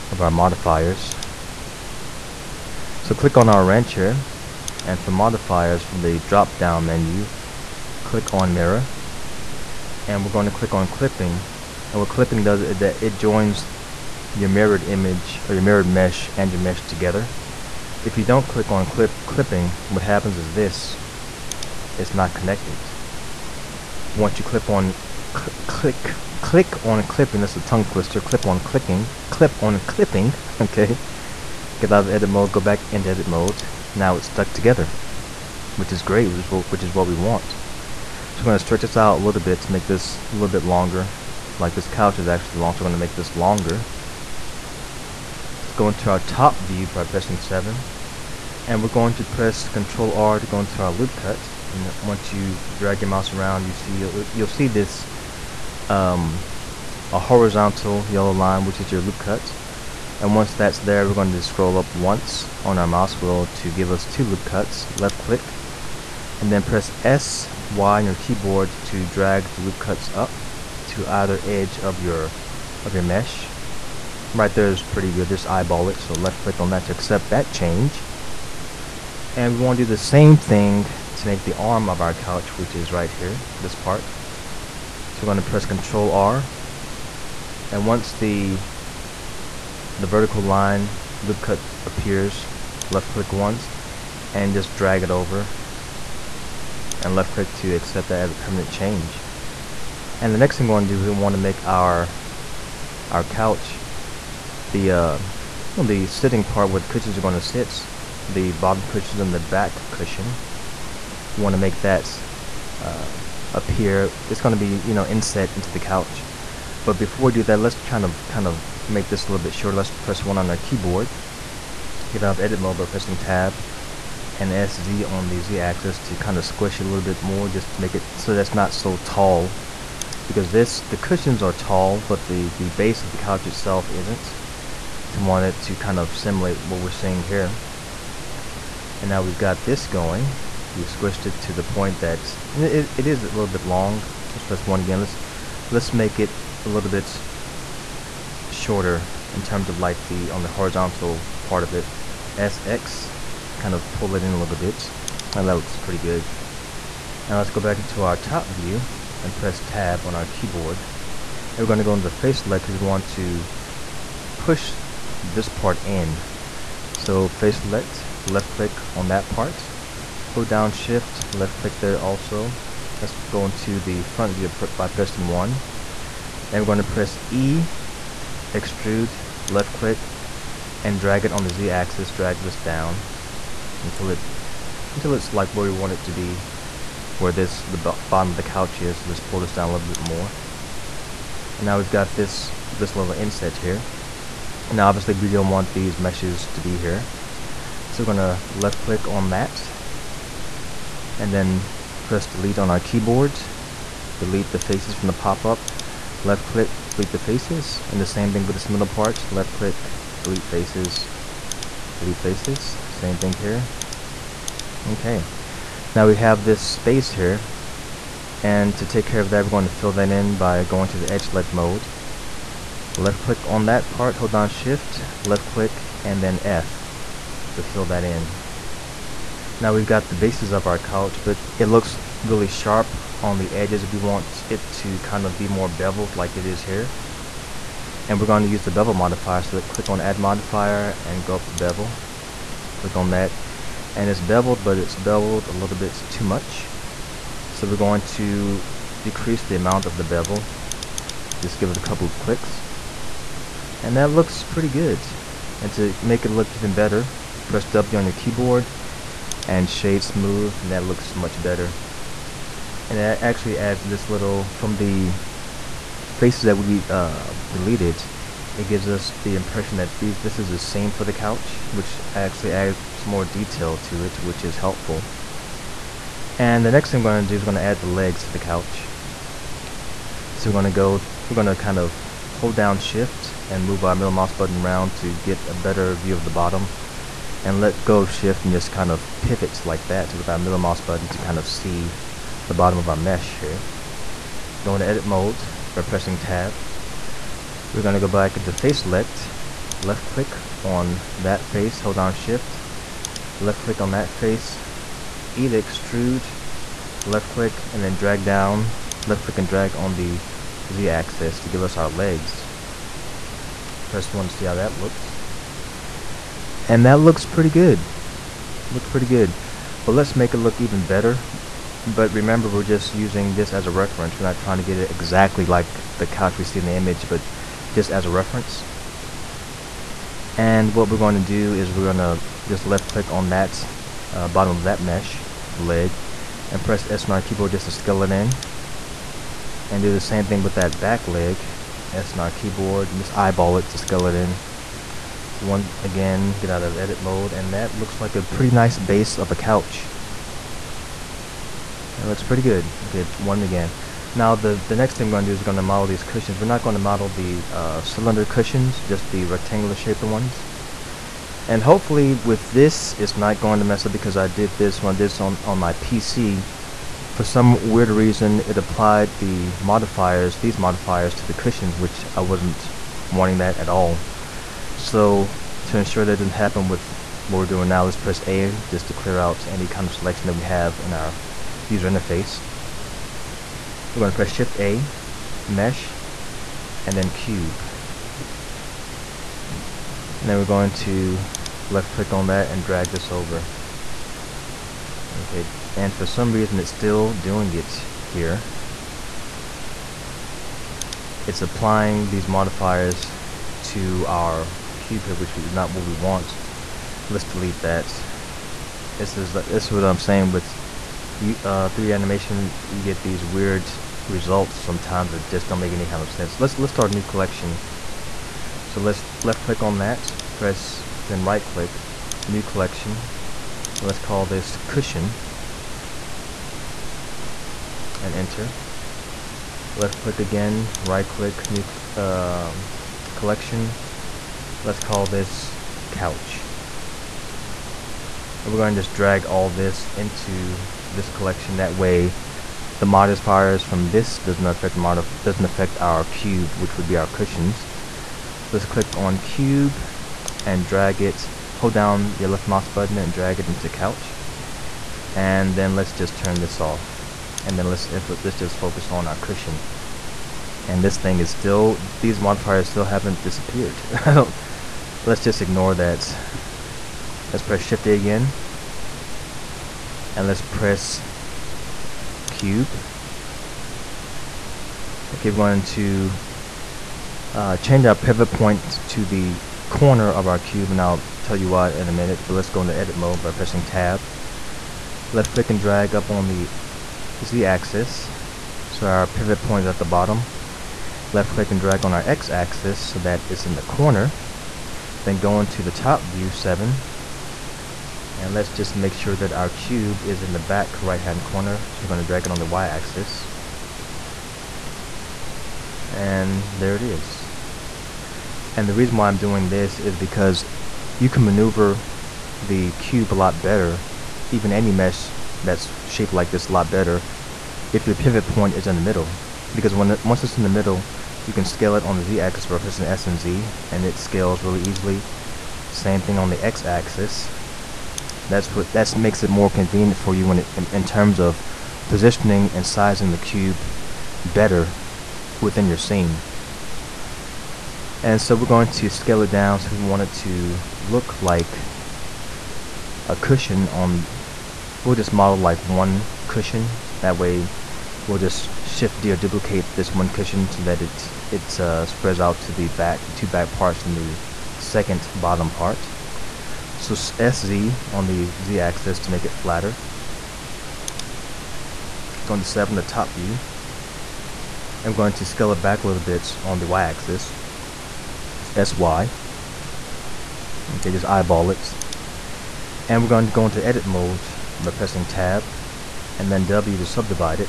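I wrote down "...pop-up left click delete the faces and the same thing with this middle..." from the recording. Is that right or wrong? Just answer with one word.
right.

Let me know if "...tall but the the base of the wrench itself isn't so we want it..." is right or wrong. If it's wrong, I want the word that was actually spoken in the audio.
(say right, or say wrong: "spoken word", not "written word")
wrong: "couch", not "wrench".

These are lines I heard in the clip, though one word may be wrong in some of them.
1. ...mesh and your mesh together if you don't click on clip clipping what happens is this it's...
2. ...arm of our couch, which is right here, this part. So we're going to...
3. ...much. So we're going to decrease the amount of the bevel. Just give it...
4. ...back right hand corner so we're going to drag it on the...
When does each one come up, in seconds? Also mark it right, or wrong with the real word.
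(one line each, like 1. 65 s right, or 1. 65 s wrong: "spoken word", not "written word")
1. 15 s right
2. 81 s right
3. 246 s right
4. 500 s right.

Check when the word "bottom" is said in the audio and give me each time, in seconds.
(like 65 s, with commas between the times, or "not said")
108 s, 187 s, 286 s, 292 s, 334 s, 489 s, 555 s.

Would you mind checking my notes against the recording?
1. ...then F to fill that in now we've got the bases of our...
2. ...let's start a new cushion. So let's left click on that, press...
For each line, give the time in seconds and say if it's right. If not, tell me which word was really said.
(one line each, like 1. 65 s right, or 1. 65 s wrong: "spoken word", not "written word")
1. 226 s right
2. 416 s wrong: "collection", not "cushion".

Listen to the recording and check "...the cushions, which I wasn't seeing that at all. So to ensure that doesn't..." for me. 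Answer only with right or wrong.
wrong.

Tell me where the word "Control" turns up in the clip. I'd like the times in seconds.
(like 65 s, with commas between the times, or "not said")
49 s, 85 s.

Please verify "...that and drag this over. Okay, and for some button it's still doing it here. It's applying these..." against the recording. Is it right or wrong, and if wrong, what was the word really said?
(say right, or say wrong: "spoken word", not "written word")
wrong: "reason", not "button".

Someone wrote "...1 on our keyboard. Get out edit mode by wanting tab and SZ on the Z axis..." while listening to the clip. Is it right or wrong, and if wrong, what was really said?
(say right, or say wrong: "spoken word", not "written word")
wrong: "pressing", not "wanting".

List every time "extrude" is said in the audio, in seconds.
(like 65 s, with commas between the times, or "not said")
178 s, 305 s.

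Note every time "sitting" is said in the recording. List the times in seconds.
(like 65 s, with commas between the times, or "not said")
106 s.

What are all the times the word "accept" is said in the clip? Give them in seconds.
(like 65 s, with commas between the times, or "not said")
76 s, 97 s.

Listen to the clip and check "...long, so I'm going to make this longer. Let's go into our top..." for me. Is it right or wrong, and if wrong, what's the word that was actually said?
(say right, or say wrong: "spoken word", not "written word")
right.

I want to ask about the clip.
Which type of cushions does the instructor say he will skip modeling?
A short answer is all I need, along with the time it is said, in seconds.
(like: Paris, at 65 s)
Cylinder cushions, at 357 s.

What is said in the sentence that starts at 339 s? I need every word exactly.
And do the same thing with that back leg, S on our keyboard, and just eyeball it to scale it in.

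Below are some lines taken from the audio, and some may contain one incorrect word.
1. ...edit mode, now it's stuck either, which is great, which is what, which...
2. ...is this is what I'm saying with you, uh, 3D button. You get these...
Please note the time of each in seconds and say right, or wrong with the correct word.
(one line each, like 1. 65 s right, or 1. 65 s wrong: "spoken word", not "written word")
1. 33 s wrong: "together", not "either"
2. 409 s wrong: "animation", not "button".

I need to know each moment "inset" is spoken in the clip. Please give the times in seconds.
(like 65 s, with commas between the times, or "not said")
115 s, 193 s.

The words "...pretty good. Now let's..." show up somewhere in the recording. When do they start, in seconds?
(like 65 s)
155 s.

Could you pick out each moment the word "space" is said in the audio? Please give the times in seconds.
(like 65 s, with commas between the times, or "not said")
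216 s.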